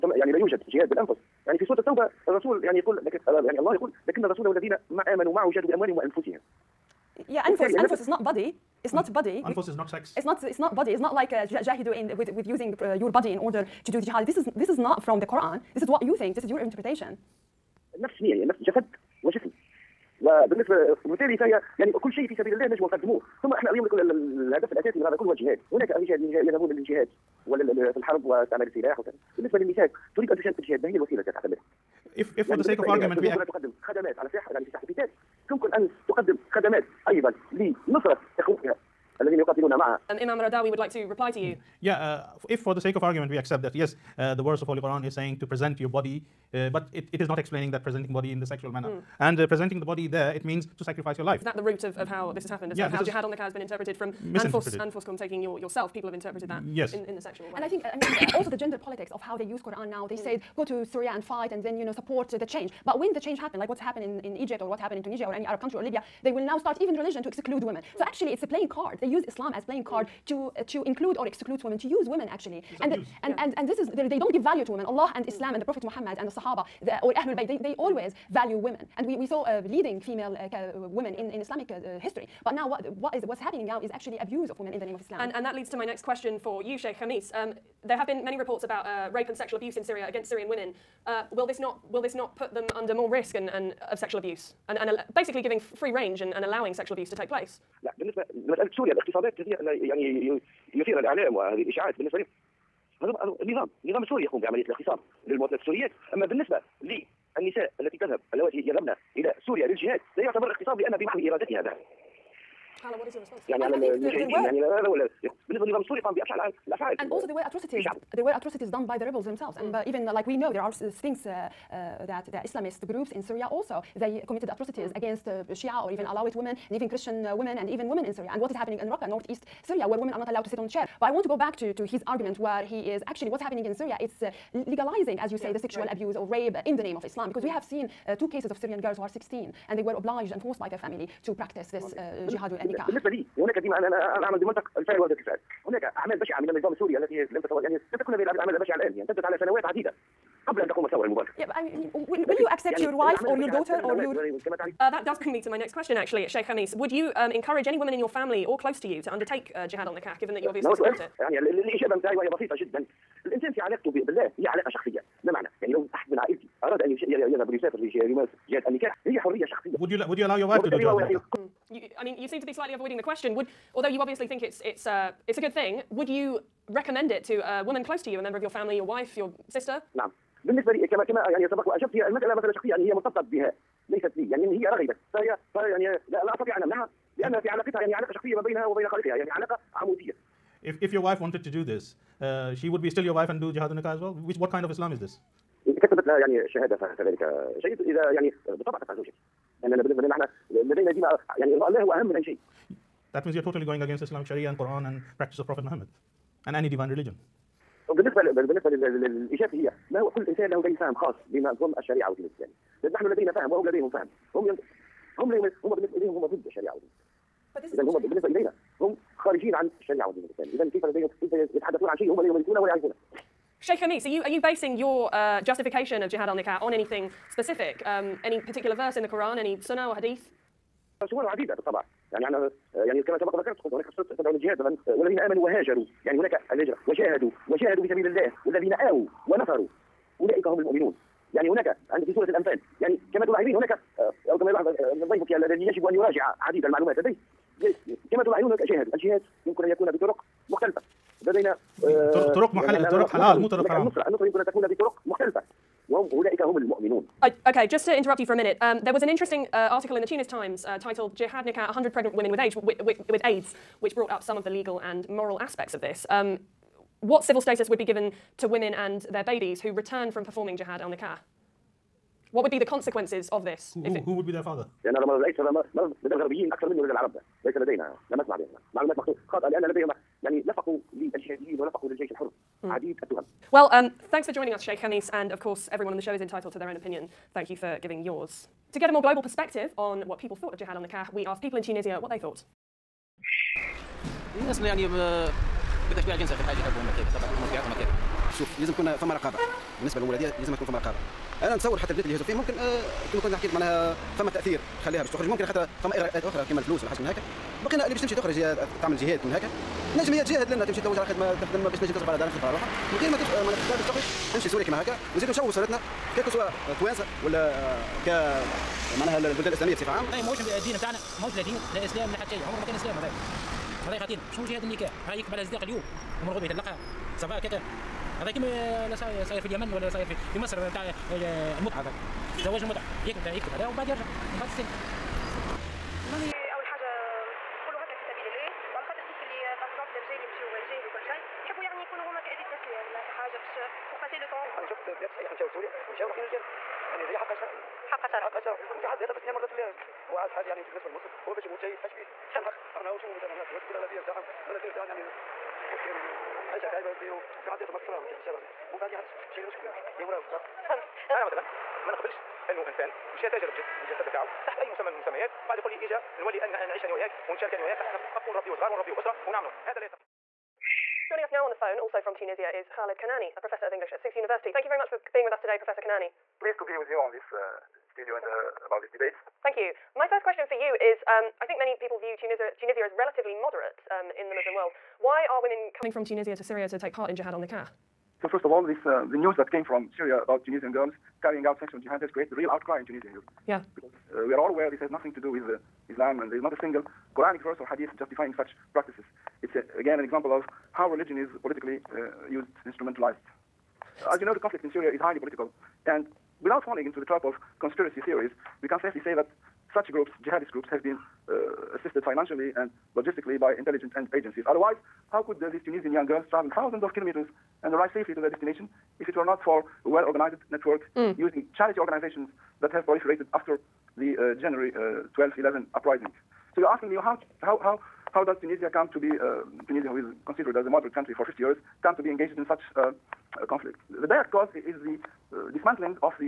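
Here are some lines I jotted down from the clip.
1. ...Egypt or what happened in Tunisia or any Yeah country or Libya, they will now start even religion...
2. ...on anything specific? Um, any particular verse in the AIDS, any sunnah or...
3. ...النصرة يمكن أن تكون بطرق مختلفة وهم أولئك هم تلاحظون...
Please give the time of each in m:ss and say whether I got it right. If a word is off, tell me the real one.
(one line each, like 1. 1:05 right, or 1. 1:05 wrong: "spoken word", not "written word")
1. 1:04 wrong: "Arab", not "Yeah"
2. 3:46 wrong: "Quran", not "AIDS"
3. 4:14 wrong: "المؤمنون", not "تلاحظون".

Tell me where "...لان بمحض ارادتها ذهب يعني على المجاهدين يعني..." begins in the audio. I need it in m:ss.
1:50.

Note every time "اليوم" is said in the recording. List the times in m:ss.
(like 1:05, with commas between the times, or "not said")
5:25.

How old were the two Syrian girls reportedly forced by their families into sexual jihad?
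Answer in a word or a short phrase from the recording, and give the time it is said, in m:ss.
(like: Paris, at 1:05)
16, at 2:19.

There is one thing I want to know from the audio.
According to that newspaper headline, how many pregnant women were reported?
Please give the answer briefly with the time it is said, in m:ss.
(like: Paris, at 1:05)
100, at 4:21.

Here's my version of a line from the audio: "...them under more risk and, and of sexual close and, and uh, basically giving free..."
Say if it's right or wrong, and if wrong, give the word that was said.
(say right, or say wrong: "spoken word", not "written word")
wrong: "abuse", not "close".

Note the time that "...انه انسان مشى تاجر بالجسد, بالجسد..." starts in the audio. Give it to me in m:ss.
6:02.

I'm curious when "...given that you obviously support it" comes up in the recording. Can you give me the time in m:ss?
2:40.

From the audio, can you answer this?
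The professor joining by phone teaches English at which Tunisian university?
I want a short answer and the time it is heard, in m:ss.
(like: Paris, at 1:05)
Sousse University, at 6:13.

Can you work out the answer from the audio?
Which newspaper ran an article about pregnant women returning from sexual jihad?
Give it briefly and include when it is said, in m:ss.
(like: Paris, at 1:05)
Tunis Times, at 4:20.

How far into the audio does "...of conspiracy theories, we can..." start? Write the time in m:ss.
6:47.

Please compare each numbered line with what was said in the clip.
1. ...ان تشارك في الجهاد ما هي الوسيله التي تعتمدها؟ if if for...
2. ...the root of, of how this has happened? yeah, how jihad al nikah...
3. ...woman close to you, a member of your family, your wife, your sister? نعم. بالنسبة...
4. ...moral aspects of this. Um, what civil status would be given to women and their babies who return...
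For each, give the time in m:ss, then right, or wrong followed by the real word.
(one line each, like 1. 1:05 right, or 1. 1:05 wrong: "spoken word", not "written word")
1. 0:30 right
2. 0:51 right
3. 2:57 right
4. 4:25 right.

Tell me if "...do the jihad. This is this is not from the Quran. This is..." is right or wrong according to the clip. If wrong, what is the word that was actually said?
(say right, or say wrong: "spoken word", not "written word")
right.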